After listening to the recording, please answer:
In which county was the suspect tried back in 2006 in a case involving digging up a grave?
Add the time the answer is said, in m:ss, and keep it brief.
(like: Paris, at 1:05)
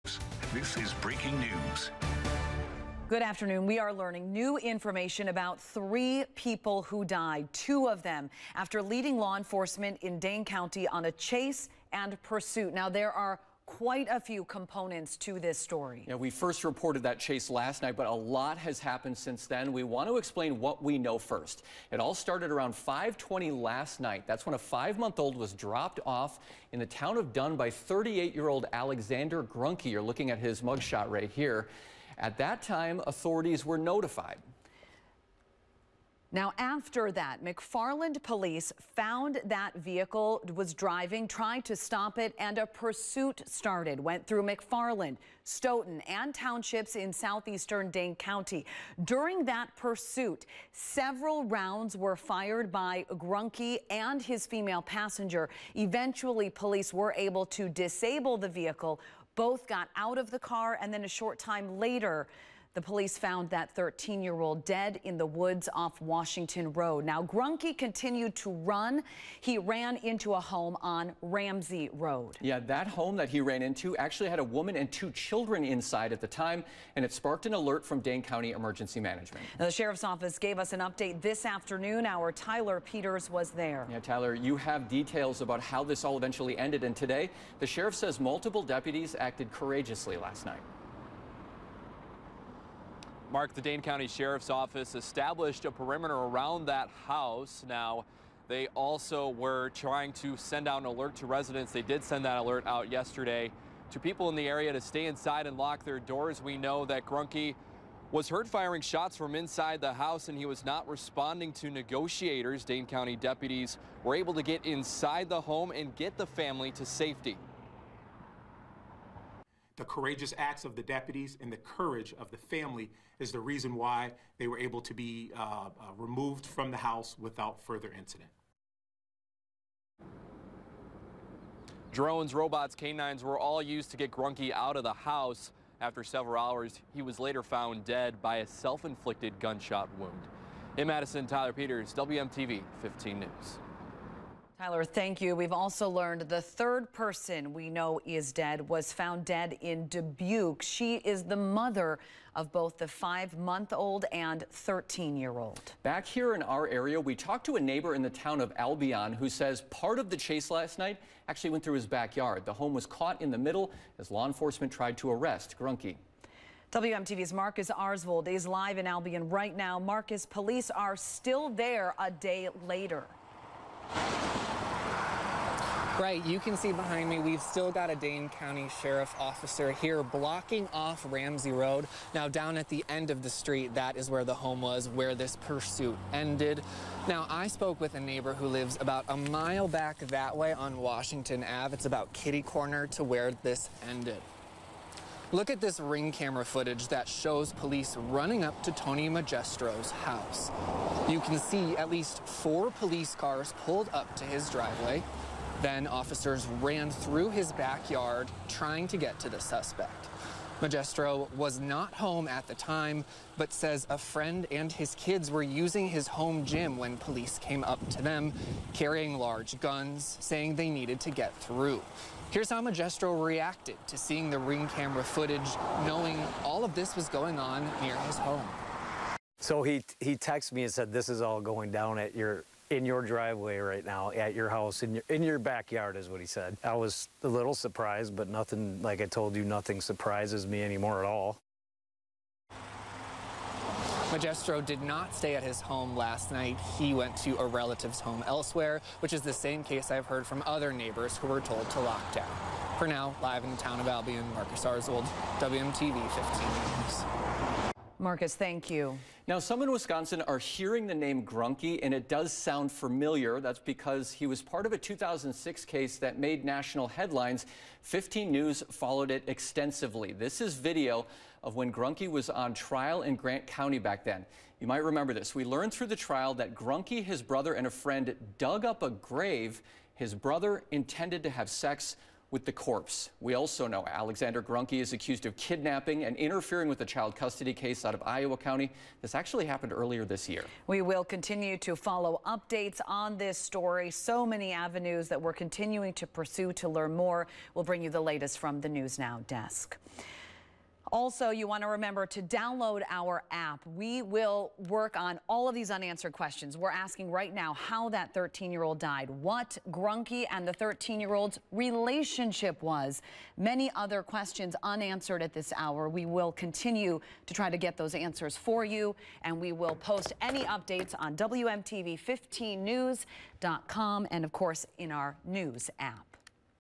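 Grant County, at 4:33.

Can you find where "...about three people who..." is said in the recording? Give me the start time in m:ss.
0:05.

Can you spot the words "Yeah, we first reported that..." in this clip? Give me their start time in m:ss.
0:16.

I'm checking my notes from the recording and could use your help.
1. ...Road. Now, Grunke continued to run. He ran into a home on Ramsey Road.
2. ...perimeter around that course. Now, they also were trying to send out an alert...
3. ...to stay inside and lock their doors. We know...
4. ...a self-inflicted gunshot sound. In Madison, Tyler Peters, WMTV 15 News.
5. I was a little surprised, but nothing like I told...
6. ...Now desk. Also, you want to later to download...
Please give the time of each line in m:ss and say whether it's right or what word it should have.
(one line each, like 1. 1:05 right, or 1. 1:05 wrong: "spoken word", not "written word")
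1. 1:06 right
2. 1:35 wrong: "house", not "course"
3. 1:44 right
4. 2:18 wrong: "wound", not "sound"
5. 3:56 right
6. 4:58 wrong: "remember", not "later".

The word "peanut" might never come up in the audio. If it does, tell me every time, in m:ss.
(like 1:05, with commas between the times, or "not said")
not said.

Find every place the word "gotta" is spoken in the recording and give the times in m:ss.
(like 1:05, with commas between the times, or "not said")
not said.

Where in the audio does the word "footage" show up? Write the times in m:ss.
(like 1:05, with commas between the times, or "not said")
3:16, 3:45.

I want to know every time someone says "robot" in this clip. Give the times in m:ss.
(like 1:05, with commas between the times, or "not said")
2:12.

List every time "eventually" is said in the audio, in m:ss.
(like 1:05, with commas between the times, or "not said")
0:55, 1:26.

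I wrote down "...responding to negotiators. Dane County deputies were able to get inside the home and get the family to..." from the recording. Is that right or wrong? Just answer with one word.
right.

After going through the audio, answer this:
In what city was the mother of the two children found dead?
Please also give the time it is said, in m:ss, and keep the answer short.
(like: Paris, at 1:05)
Dubuque, at 2:29.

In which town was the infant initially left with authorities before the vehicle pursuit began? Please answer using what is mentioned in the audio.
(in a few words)
Dunn.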